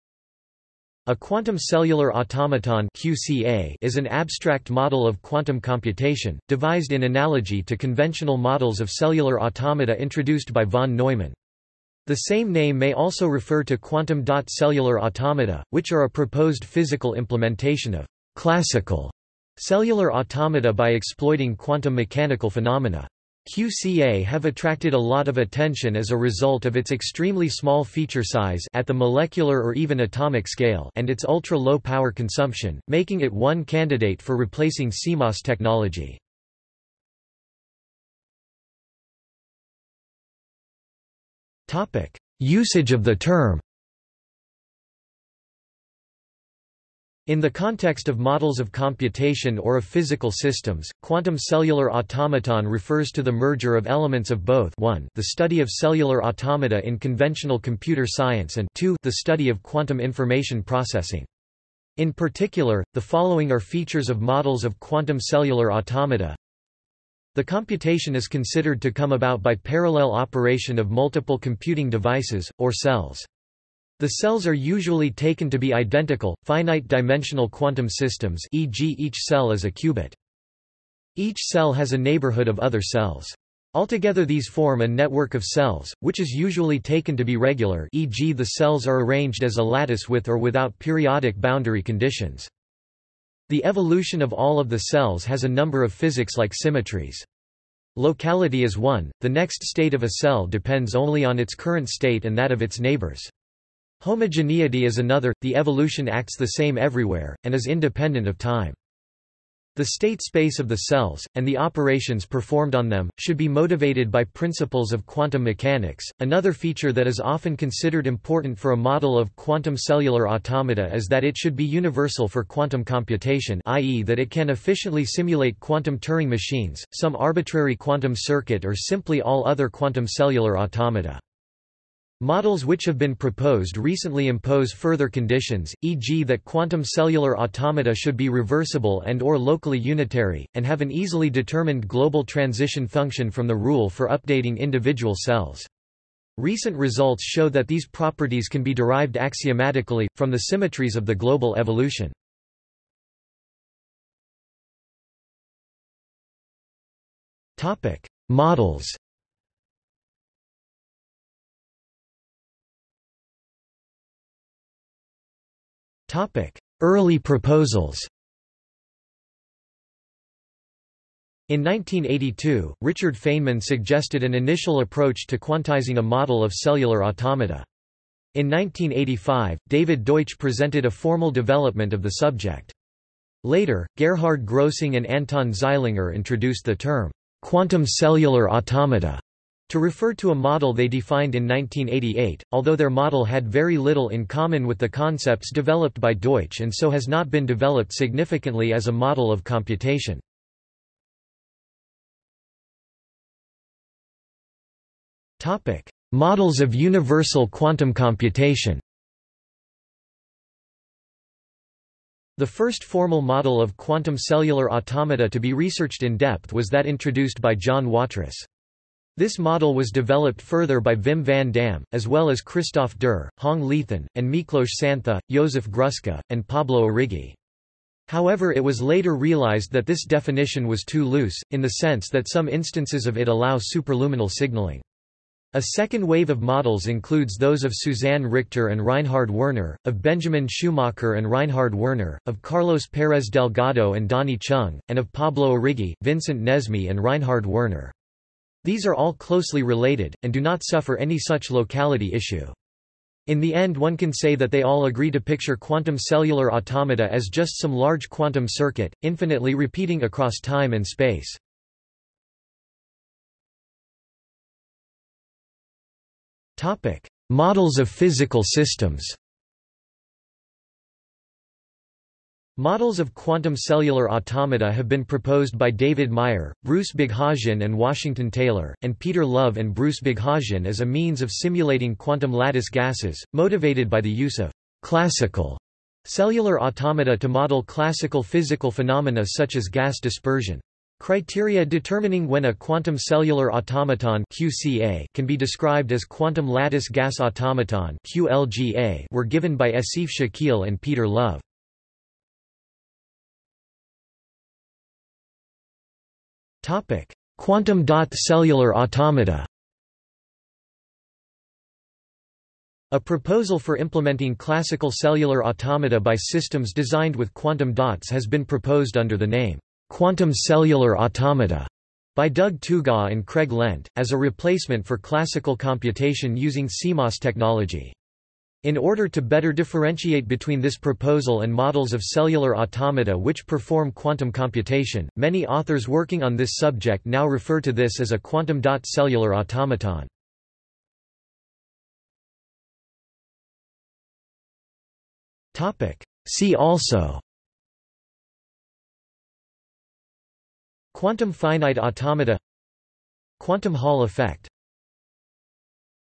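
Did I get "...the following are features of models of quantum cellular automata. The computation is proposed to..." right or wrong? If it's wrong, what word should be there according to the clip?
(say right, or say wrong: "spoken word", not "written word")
wrong: "considered", not "proposed".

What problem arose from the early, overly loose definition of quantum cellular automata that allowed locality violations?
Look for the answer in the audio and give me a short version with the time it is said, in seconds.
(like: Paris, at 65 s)
superluminal signaling, at 233 s.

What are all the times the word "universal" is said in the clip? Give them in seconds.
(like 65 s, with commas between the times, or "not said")
121 s, 206 s.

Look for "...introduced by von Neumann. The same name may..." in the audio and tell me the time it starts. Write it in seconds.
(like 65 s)
10 s.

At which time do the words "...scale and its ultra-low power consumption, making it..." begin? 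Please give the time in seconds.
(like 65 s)
30 s.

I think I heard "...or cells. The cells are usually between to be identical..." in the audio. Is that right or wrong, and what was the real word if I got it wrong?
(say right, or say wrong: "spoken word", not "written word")
wrong: "taken", not "between".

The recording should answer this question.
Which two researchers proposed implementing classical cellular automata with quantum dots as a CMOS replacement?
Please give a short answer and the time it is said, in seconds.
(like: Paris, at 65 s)
Doug Tougaw and Craig Lent, at 322 s.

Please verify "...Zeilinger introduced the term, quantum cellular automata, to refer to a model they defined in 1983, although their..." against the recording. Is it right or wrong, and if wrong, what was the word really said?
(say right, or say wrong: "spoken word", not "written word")
wrong: "1988", not "1983".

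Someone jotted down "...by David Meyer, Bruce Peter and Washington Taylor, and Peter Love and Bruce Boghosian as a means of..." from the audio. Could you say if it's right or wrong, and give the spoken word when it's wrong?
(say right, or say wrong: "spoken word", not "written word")
wrong: "Boghosian", not "Peter".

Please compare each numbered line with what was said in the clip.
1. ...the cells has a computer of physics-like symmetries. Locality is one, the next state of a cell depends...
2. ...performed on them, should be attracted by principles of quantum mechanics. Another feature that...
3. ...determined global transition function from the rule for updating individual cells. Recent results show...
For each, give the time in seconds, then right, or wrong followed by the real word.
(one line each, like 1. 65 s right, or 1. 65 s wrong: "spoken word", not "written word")
1. 94 s wrong: "number", not "computer"
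2. 112 s wrong: "motivated", not "attracted"
3. 141 s right.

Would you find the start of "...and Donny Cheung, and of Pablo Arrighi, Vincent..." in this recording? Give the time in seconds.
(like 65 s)
243 s.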